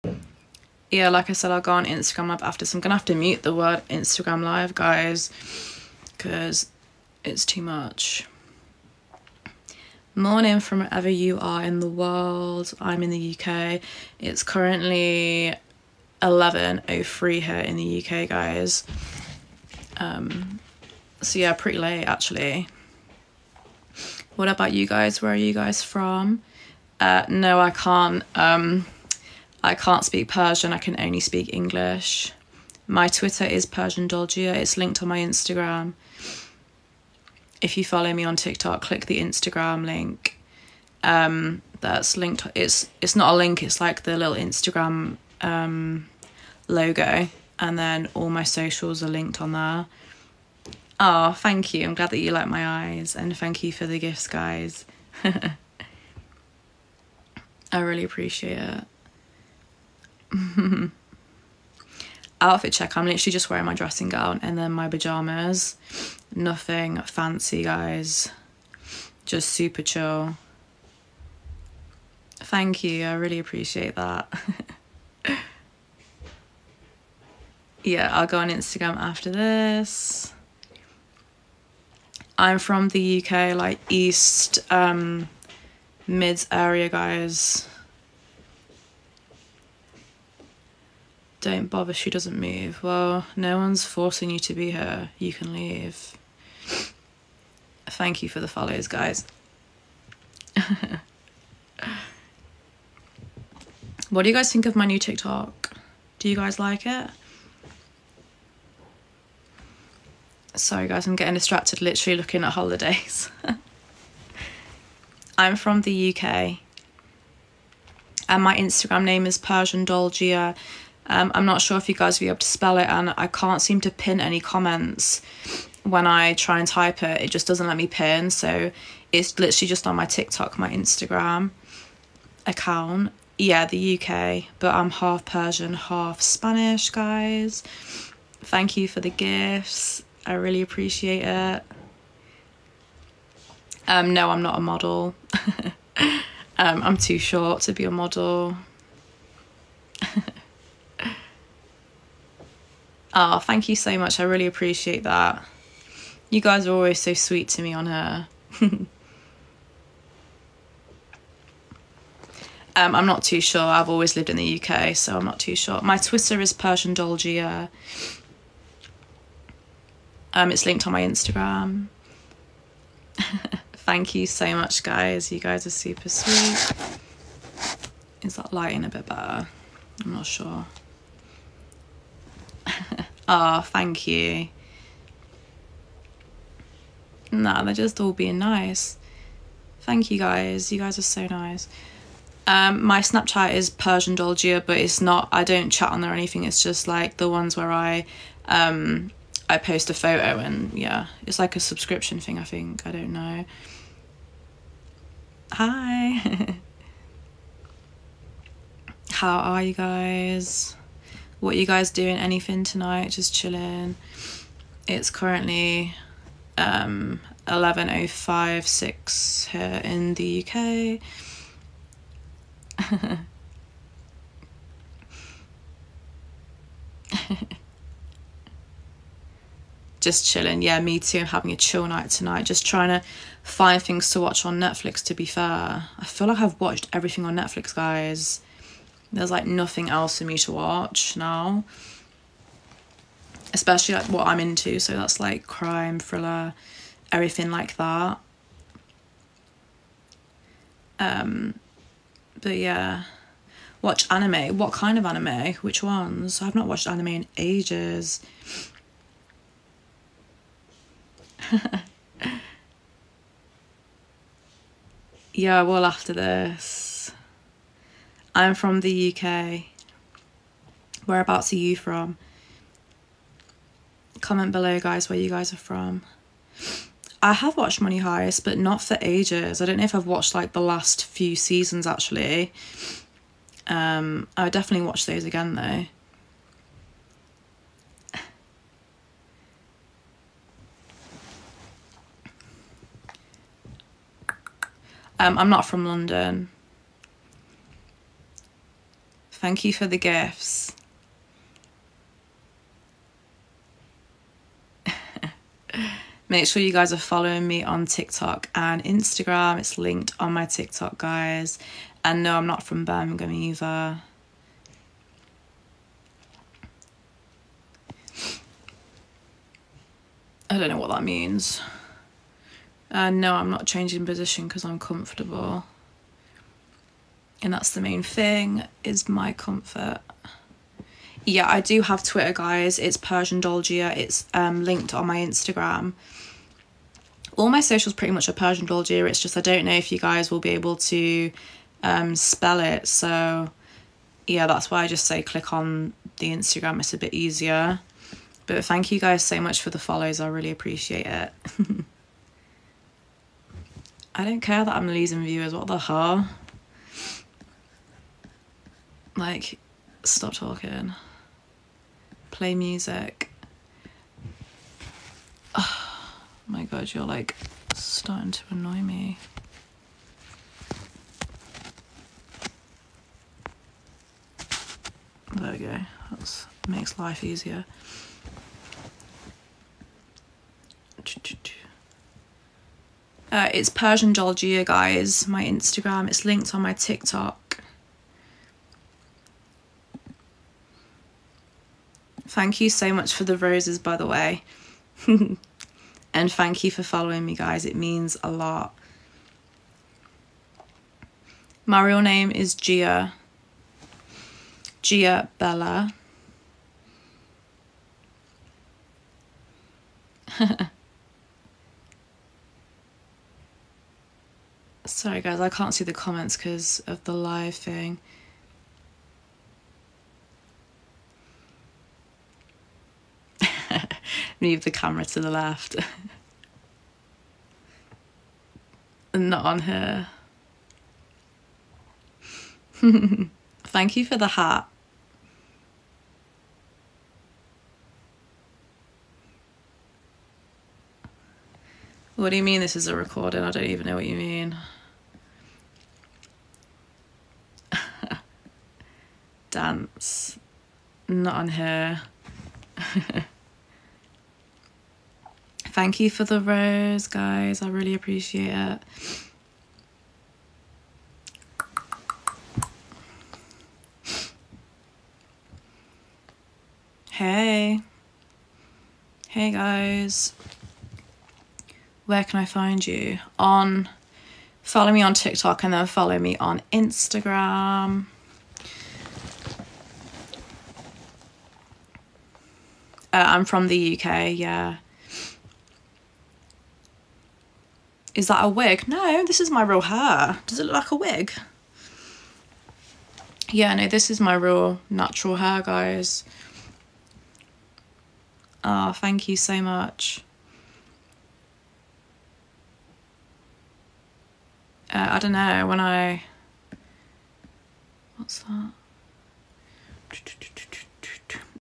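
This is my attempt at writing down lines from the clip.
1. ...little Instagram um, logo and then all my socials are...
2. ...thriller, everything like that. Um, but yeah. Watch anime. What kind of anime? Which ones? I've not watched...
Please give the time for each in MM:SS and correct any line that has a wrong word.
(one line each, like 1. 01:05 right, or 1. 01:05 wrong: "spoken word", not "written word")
1. 00:44 right
2. 04:05 right.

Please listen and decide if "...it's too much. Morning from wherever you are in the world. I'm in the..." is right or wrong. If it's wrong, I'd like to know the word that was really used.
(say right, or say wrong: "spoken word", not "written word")
right.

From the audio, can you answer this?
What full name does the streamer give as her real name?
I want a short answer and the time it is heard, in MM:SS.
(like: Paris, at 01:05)
Gia Bella, at 06:44.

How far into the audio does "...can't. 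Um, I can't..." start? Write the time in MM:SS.
00:27.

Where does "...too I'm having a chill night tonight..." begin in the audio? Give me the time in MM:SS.
03:50.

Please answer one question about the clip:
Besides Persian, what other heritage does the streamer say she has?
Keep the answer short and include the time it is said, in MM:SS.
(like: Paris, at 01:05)
Spanish, at 02:16.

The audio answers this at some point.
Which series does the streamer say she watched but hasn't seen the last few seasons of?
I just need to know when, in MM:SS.
04:37.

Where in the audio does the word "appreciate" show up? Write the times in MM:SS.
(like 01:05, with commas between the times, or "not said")
00:58, 01:13, 02:20, 02:34, 05:50, 07:37.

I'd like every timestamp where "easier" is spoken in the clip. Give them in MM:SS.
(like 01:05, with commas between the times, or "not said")
05:47, 06:17.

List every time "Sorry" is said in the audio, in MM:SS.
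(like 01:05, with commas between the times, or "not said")
01:50, 06:54.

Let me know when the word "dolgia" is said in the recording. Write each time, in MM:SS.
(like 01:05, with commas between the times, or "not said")
00:34, 02:46, 03:14, 05:33, 05:38, 06:24.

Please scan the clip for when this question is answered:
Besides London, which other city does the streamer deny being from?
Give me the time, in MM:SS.
05:12.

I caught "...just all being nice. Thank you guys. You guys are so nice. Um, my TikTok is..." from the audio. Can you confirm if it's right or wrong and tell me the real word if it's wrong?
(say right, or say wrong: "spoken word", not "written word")
wrong: "Snapchat", not "TikTok".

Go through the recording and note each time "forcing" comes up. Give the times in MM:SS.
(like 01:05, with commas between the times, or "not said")
01:33.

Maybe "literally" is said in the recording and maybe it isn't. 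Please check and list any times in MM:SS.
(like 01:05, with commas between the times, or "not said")
01:03, 01:51, 02:09.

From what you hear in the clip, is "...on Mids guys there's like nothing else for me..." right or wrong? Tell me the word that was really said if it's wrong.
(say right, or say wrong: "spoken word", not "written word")
wrong: "Netflix", not "Mids".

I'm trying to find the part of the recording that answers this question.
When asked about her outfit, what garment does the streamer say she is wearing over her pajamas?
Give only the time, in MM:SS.
01:03.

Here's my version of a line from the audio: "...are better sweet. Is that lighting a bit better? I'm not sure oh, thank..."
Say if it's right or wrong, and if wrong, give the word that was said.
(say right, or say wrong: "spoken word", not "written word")
wrong: "super", not "better".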